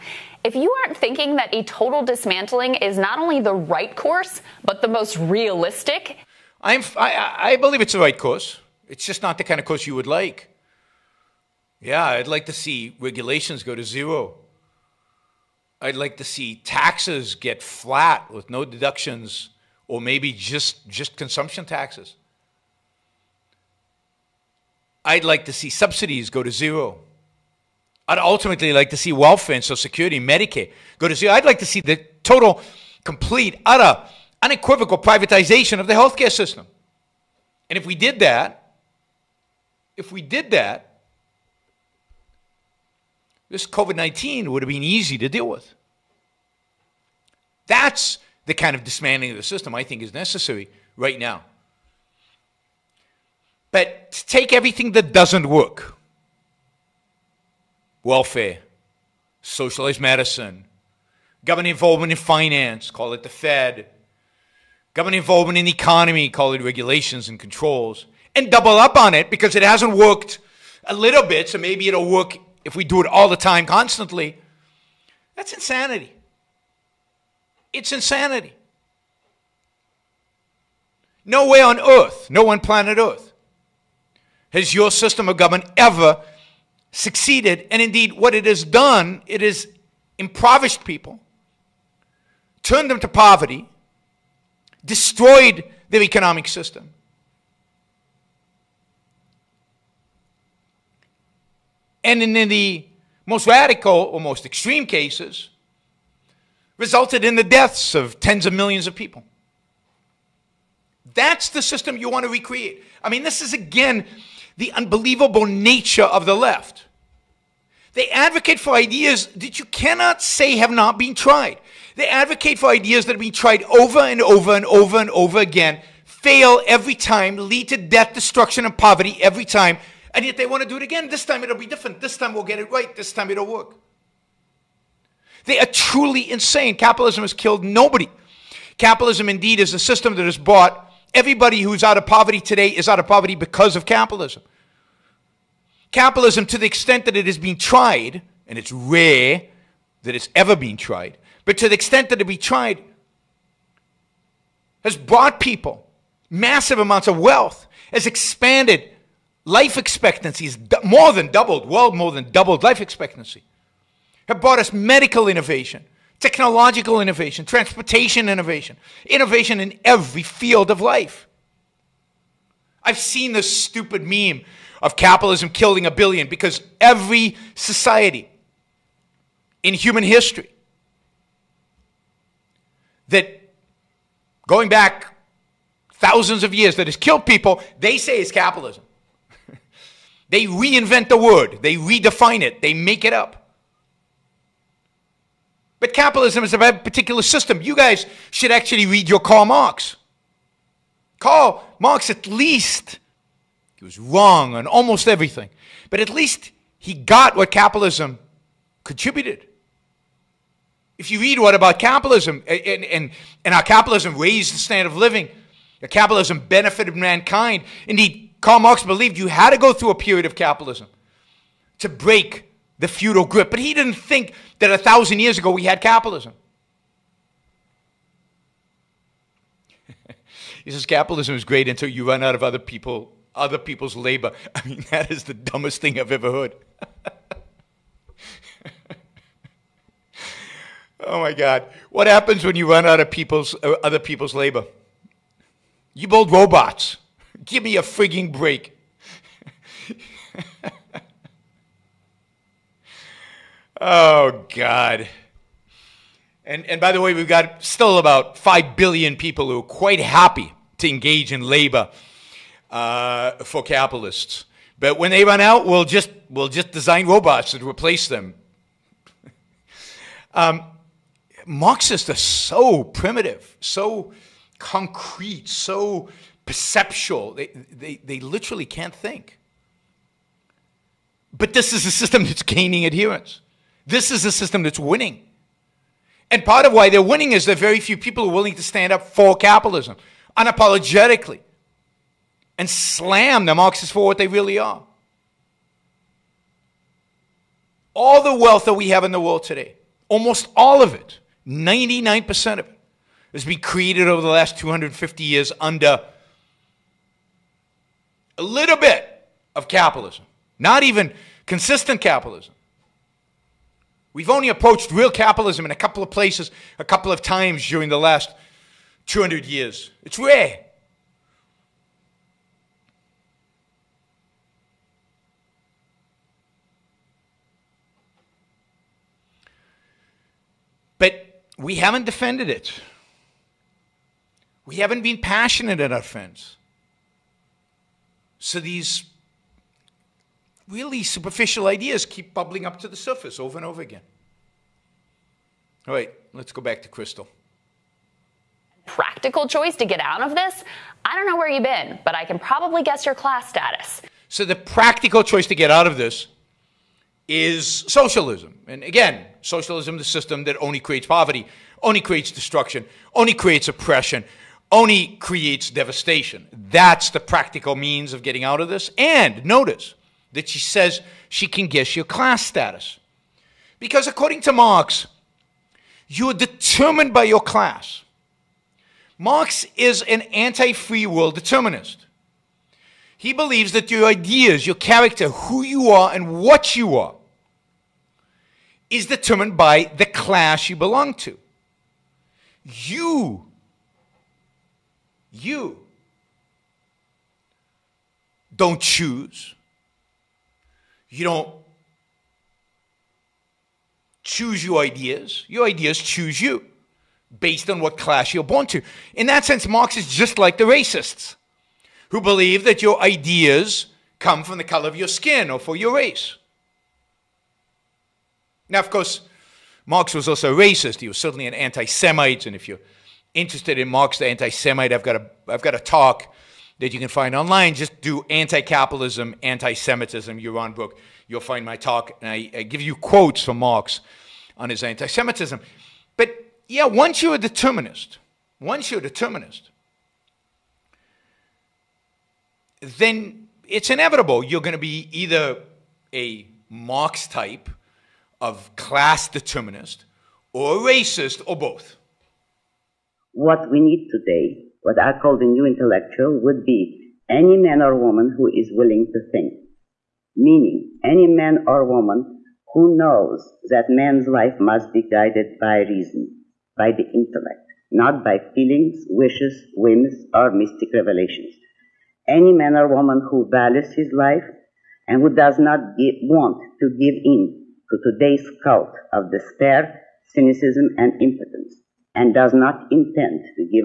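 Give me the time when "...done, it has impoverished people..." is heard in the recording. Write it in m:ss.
1:28.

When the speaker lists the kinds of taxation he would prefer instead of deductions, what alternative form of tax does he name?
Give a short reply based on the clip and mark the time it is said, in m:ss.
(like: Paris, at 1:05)
consumption taxes, at 0:21.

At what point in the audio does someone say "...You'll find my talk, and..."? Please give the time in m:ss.
7:11.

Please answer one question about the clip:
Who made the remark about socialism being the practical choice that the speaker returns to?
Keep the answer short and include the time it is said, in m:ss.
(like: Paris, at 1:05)
Crystal, at 5:46.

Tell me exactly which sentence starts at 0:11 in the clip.
Yeah, I'd like to see regulations go to zero.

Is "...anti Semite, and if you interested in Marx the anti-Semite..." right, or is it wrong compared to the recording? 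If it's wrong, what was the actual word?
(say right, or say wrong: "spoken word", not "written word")
right.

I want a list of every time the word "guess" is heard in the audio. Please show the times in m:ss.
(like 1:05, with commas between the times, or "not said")
5:52, 6:11.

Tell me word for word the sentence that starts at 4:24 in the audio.
But when they run out, we'll just, we'll just design robots to replace them.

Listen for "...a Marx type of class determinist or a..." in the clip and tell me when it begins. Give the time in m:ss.
7:26.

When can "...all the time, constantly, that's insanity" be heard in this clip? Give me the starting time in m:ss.
1:13.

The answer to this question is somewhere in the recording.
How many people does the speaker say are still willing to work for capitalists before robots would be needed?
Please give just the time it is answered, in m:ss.
4:18.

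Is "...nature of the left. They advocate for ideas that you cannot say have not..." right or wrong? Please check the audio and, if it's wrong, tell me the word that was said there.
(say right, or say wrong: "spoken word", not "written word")
right.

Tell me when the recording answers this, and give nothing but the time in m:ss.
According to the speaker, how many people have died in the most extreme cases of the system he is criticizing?
1:48.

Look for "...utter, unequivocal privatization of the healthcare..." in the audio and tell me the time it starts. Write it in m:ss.
0:33.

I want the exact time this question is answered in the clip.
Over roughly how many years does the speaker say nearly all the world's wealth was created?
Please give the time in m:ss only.
5:04.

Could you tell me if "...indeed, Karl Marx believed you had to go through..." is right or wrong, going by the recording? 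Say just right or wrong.
right.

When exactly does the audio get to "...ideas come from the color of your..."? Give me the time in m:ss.
6:53.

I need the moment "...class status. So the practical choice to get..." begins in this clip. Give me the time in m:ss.
5:53.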